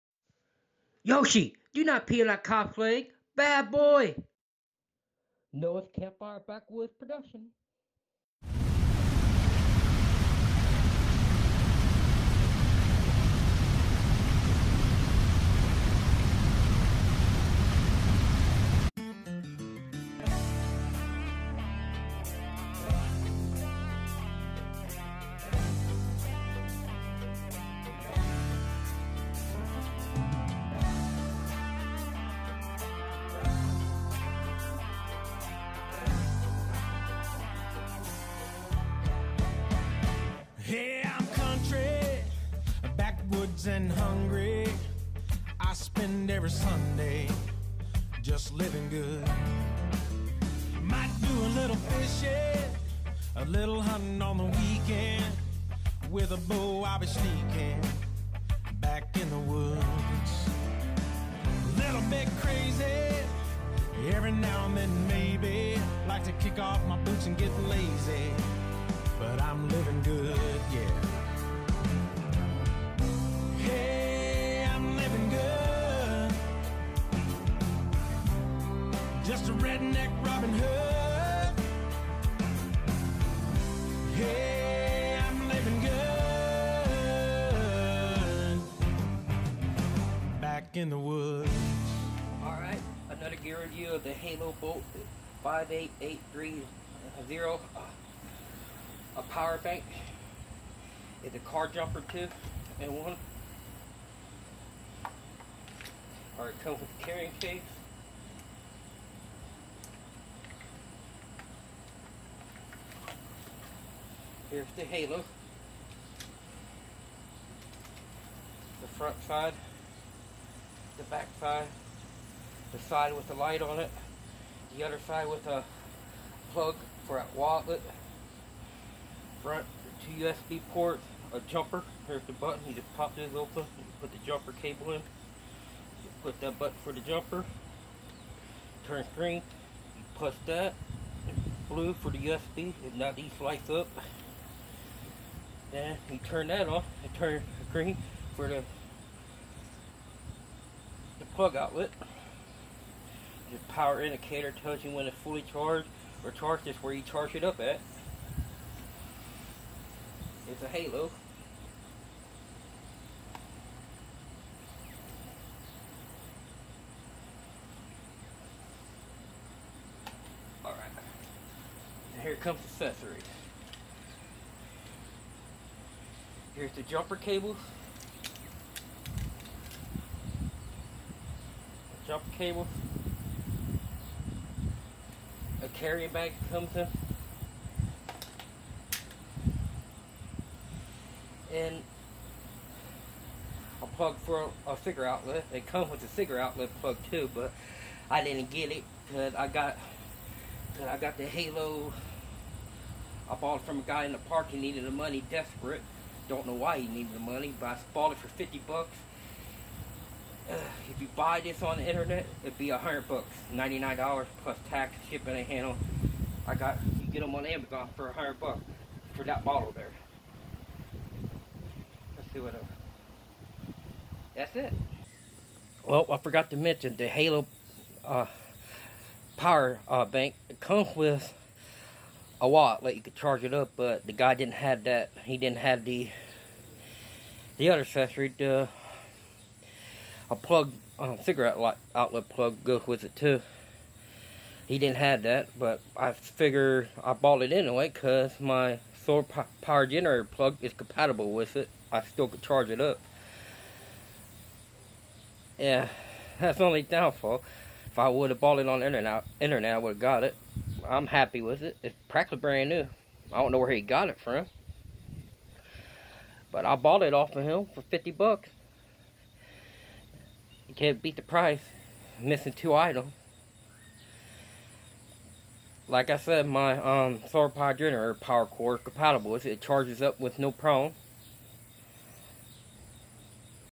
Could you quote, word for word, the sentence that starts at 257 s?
If I would have bought it on internet, internet I would have got it.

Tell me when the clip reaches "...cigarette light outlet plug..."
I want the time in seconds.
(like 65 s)
241 s.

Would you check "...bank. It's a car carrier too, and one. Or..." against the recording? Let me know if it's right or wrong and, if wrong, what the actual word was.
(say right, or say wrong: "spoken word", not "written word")
wrong: "jumper", not "carrier".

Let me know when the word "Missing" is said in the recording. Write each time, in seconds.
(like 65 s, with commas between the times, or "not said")
272 s.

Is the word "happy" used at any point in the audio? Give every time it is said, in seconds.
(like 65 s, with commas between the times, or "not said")
261 s.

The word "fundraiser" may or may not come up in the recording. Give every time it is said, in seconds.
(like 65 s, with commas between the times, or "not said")
not said.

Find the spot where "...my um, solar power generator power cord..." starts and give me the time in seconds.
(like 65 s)
276 s.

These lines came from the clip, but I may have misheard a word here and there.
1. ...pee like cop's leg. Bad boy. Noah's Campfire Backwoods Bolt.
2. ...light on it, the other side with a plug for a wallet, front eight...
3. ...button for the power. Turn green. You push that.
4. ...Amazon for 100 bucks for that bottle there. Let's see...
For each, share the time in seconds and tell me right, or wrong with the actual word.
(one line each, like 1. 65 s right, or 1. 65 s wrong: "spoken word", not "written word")
1. 2 s wrong: "Production", not "Bolt"
2. 123 s wrong: "two", not "eight"
3. 136 s wrong: "jumper", not "power"
4. 217 s right.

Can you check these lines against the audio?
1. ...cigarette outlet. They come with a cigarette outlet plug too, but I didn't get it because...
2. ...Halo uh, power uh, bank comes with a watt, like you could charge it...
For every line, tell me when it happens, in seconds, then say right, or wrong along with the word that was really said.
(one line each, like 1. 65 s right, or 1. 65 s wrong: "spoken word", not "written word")
1. 194 s right
2. 227 s right.